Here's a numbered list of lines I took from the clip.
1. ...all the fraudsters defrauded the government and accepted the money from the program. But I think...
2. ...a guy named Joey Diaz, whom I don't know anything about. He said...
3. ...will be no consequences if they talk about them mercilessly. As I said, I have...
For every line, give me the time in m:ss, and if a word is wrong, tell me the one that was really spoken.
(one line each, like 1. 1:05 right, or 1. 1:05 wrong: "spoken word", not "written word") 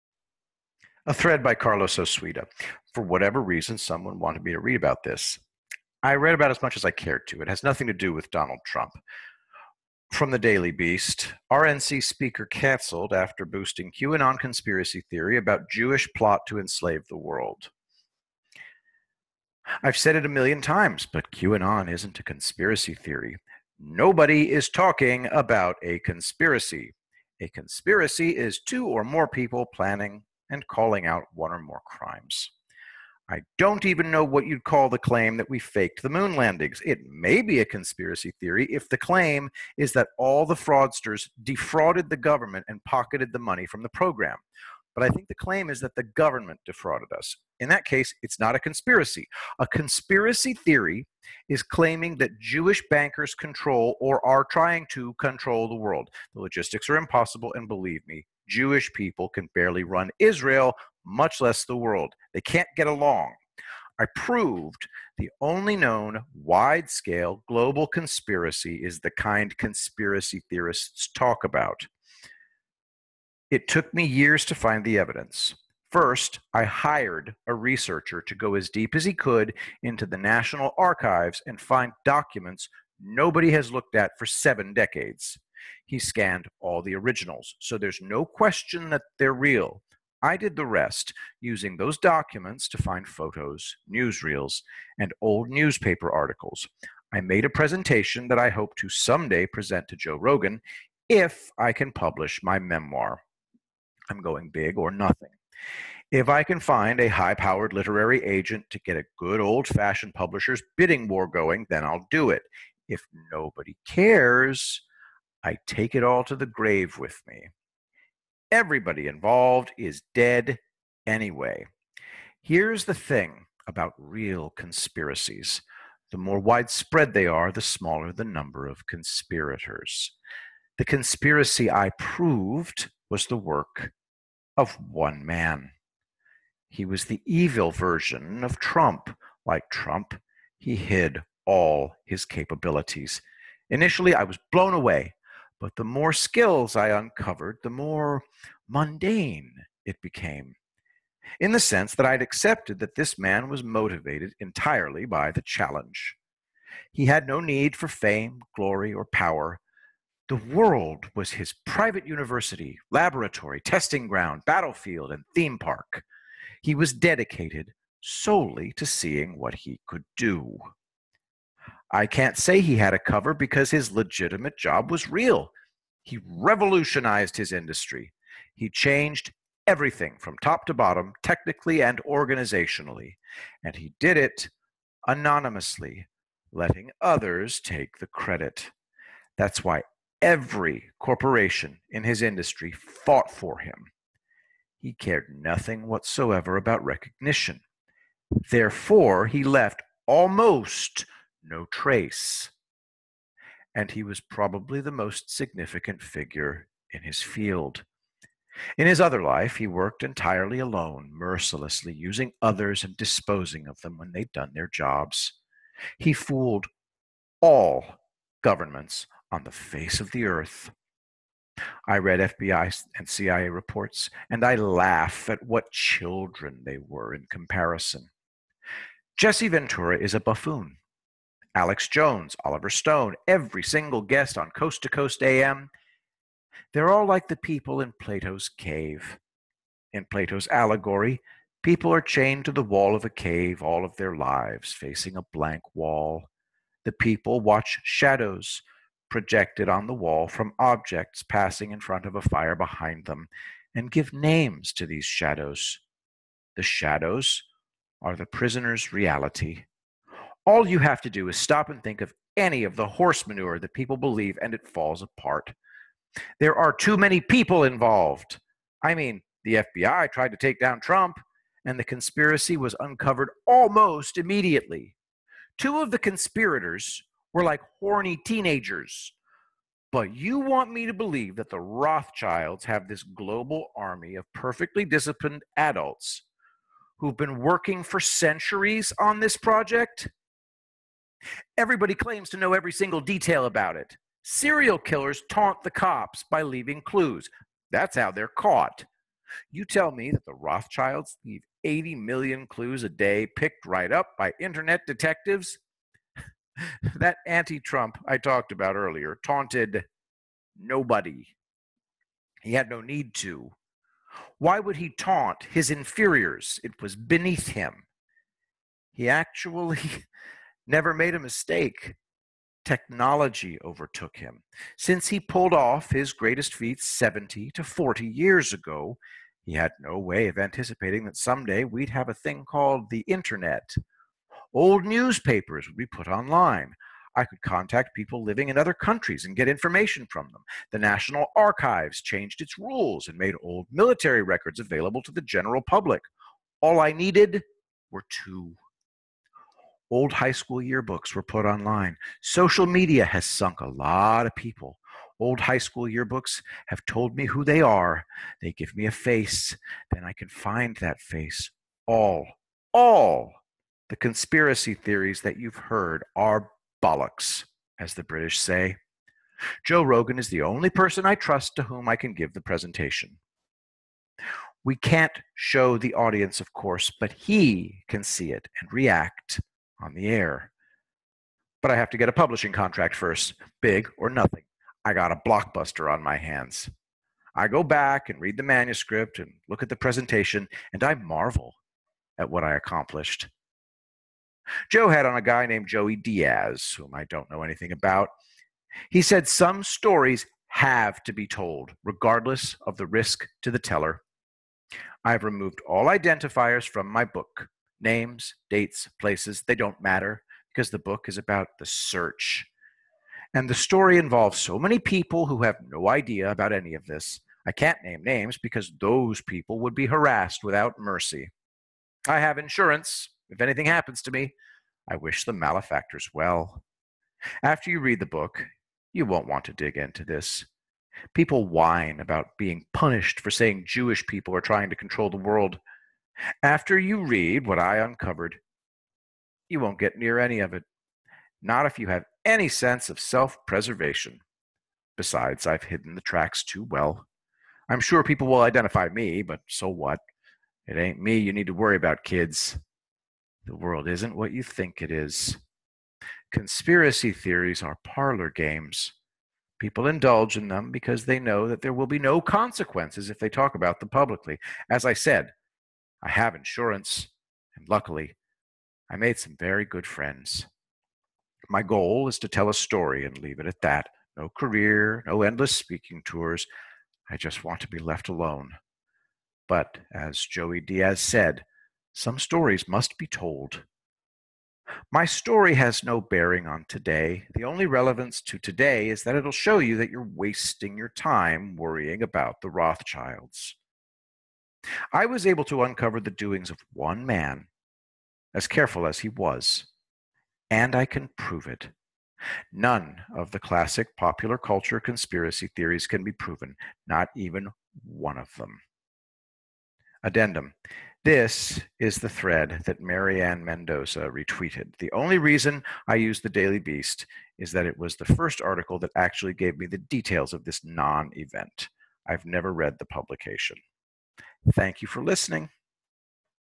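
1. 0:40 wrong: "pocketed", not "accepted"
2. 6:35 right
3. 7:41 wrong: "publicly", not "mercilessly".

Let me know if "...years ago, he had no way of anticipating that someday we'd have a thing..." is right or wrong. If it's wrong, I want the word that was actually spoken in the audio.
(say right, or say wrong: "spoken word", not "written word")
right.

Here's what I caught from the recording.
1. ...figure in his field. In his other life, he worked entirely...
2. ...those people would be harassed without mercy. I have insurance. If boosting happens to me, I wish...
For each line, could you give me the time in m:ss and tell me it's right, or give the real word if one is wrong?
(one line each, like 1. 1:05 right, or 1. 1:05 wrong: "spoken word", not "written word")
1. 3:26 right
2. 6:58 wrong: "anything", not "boosting".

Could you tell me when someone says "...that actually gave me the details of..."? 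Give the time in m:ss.
8:38.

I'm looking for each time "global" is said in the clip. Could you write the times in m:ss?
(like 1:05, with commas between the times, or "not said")
1:07, 4:43.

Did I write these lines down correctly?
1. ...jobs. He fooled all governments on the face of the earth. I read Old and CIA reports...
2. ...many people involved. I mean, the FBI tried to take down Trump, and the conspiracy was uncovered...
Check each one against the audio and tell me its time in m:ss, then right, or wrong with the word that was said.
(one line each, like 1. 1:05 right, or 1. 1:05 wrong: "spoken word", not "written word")
1. 3:34 wrong: "FBI", not "Old"
2. 4:26 right.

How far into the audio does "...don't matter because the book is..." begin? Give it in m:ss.
6:49.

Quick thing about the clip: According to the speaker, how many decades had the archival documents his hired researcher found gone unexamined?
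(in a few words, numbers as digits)
7.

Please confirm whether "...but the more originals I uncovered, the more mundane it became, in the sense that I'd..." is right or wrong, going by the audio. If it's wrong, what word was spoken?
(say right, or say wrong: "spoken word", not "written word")
wrong: "skills", not "originals".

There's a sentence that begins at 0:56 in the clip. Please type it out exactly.
The logistics are impossible, and believe me, Jewish people can barely run Israel, much less the world.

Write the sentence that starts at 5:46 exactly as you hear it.
All I needed were two Old high school yearbooks were put online.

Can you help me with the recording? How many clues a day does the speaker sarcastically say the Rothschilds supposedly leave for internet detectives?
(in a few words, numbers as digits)
80 million.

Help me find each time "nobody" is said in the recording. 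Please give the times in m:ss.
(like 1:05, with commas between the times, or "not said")
0:23, 1:23, 1:53, 5:10.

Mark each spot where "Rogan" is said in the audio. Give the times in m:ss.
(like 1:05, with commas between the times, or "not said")
1:40, 6:09.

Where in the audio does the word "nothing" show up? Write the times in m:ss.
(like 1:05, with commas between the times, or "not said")
0:07, 1:44, 3:15, 6:24.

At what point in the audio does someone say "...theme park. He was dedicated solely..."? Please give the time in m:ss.
2:45.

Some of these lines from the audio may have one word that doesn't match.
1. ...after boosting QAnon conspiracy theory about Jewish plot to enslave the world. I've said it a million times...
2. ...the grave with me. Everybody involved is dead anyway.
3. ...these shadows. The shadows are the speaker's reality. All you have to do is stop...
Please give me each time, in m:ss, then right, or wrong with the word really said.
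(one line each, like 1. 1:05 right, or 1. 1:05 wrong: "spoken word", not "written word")
1. 0:13 right
2. 1:56 right
3. 4:14 wrong: "prisoner", not "speaker".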